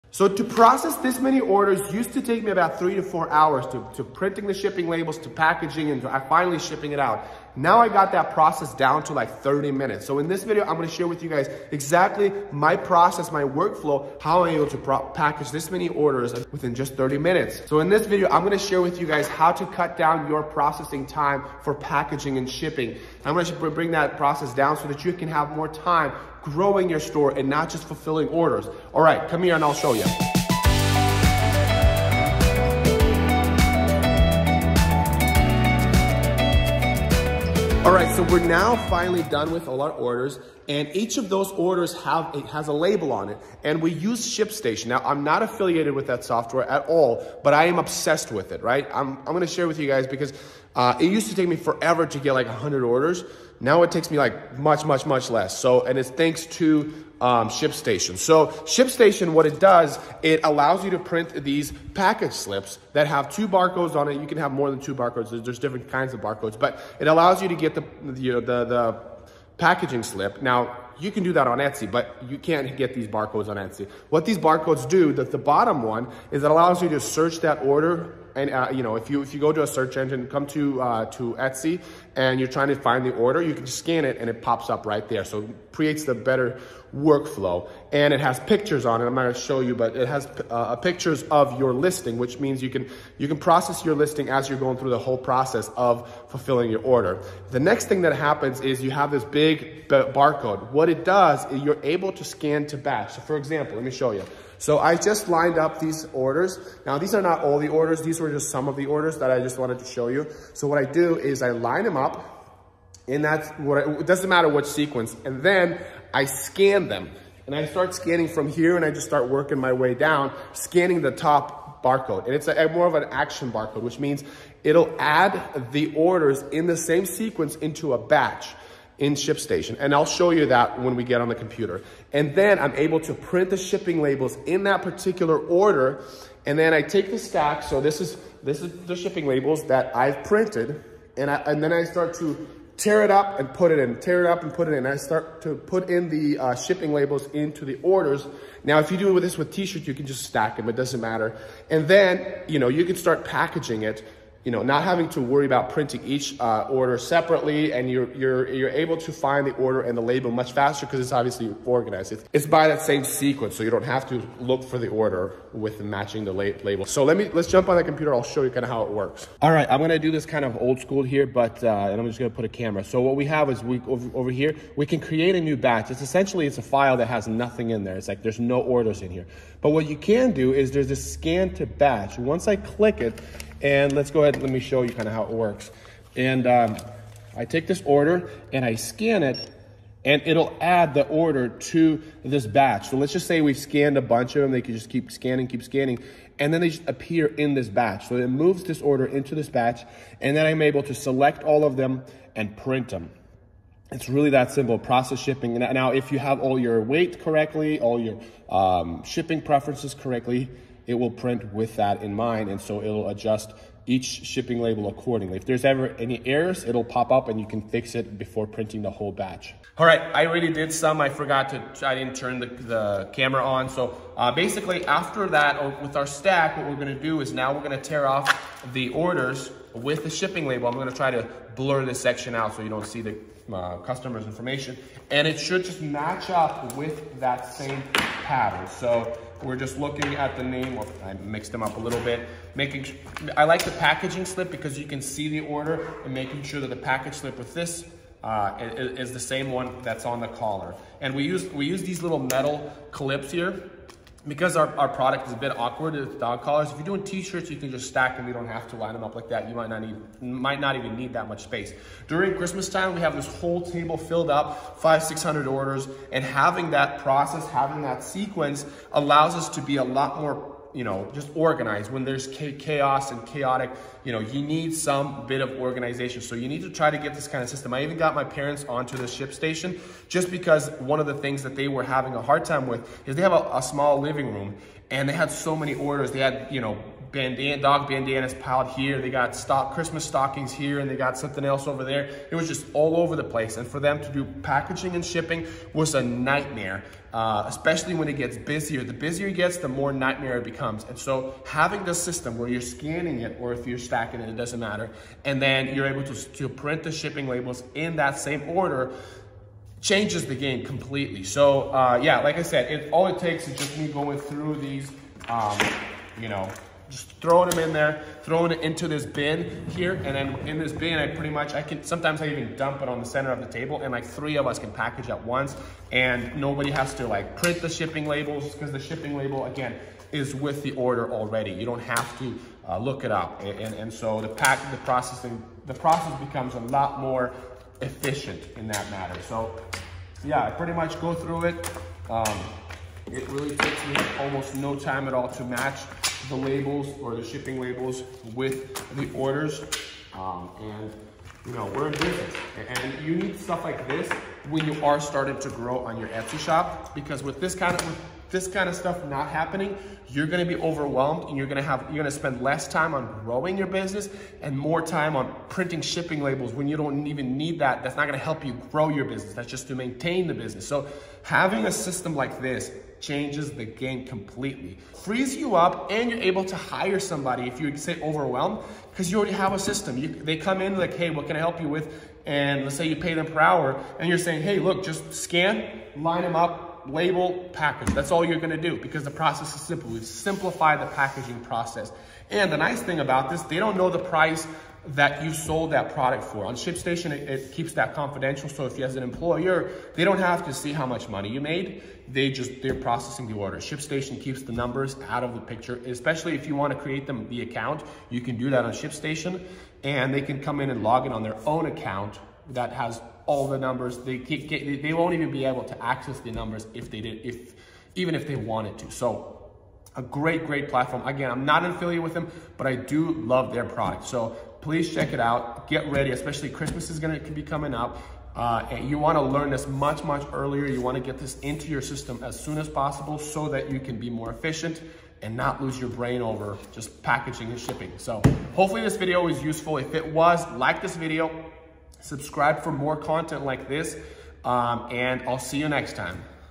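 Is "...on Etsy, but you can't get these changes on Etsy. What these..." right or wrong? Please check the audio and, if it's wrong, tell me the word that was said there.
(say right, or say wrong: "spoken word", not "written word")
wrong: "barcodes", not "changes".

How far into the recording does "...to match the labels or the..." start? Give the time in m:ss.
5:45.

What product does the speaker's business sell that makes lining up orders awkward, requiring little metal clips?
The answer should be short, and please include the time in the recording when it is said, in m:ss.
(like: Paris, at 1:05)
Dog collars, at 4:16.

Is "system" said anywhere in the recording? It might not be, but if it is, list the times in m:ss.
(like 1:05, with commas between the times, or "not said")
4:37, 5:01, 6:11, 6:19, 7:11.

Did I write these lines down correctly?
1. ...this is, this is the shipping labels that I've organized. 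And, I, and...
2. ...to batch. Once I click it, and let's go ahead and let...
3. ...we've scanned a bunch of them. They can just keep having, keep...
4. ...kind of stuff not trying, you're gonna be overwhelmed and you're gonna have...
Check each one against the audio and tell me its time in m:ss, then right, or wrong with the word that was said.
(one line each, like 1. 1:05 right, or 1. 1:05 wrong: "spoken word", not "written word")
1. 2:17 wrong: "printed", not "organized"
2. 3:01 right
3. 3:13 wrong: "scanning", not "having"
4. 5:58 wrong: "happening", not "trying".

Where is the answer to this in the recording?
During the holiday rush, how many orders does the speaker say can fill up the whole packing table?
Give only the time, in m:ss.
4:24.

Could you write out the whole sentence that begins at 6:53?
They, they won't even be able to access the numbers if they did, if even if they wanted to.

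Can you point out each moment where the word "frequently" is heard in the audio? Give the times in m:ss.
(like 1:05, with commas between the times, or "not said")
not said.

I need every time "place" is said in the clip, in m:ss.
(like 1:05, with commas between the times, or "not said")
4:53.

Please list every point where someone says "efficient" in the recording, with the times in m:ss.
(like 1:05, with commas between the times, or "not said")
5:37, 7:14.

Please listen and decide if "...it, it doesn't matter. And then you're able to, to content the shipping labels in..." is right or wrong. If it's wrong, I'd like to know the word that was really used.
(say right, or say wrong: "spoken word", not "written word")
wrong: "print", not "content".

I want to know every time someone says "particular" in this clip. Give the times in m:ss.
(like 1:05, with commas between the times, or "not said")
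2:14.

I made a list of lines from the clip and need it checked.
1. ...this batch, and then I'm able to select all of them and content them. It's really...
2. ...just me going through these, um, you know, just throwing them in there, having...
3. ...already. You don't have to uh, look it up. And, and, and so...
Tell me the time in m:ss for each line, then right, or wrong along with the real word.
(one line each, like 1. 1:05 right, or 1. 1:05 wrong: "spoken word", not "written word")
1. 3:19 wrong: "print", not "content"
2. 5:13 wrong: "throwing", not "having"
3. 5:31 right.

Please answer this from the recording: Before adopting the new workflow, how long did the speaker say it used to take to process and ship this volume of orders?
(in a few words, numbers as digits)
3 to 4 hours.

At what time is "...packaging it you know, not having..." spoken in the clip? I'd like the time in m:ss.
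2:33.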